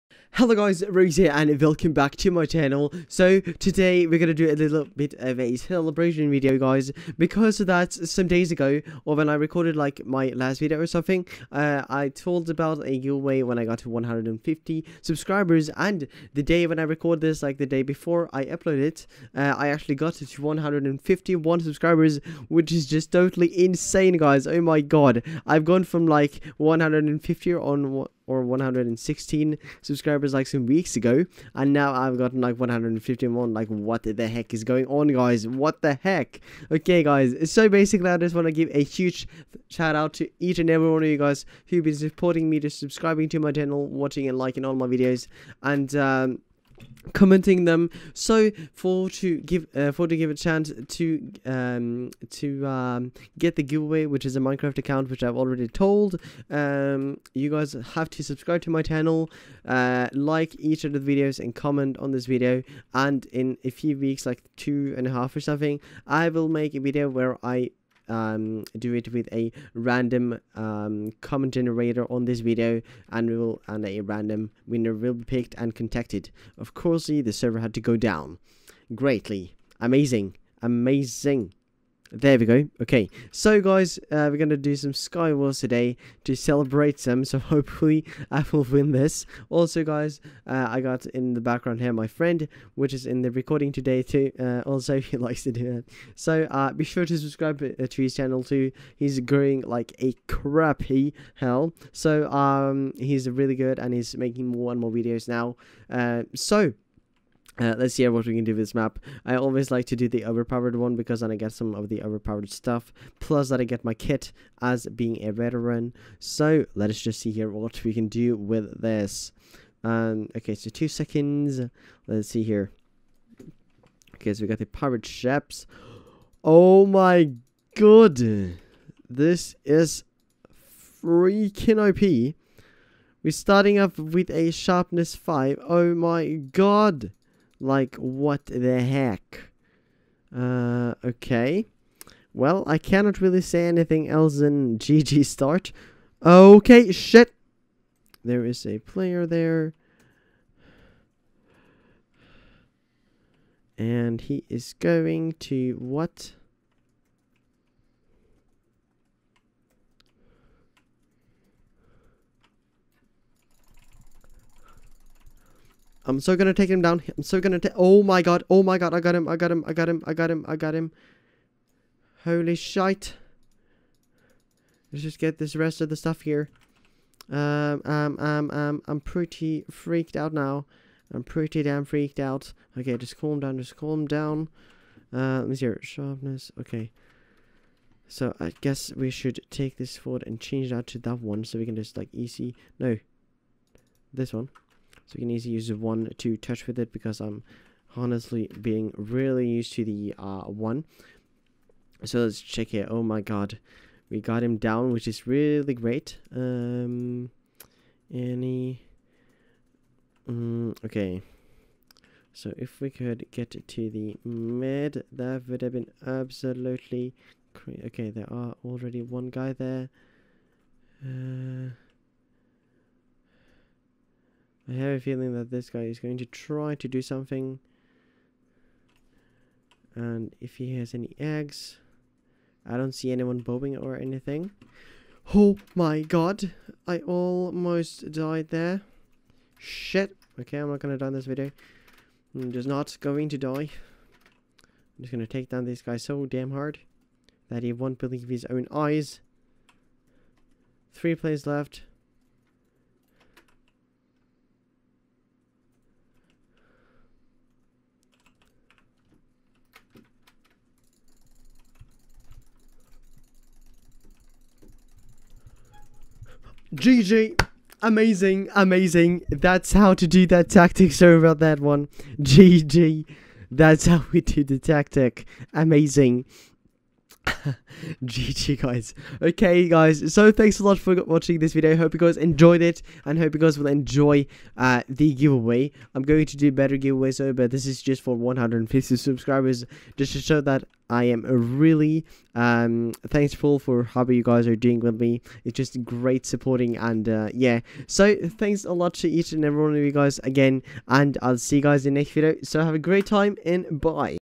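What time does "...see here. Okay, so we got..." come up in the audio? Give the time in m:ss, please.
2:02.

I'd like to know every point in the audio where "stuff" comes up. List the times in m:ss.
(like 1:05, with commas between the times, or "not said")
1:52, 2:55.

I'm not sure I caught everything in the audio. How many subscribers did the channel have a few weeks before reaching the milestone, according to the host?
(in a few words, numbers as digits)
116.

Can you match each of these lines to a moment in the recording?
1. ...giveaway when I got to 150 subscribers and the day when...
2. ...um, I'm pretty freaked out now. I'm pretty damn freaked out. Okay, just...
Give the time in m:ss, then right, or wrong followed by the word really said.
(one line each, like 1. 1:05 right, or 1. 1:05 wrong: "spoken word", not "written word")
1. 0:12 right
2. 2:58 right.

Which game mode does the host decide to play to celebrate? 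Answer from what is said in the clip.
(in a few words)
Skywars.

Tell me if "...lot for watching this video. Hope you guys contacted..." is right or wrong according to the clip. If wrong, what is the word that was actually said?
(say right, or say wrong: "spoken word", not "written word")
wrong: "enjoyed", not "contacted".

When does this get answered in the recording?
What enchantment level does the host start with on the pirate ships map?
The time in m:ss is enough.
2:14.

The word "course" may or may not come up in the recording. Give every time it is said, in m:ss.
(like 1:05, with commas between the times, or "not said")
1:16.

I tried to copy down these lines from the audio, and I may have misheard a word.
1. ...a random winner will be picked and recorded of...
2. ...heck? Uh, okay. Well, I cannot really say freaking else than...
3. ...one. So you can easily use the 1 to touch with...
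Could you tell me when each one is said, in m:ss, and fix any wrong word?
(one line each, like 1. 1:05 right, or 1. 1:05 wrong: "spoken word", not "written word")
1. 1:13 wrong: "contacted", not "recorded"
2. 2:18 wrong: "anything", not "freaking"
3. 3:14 right.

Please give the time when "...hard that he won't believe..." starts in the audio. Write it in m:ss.
4:06.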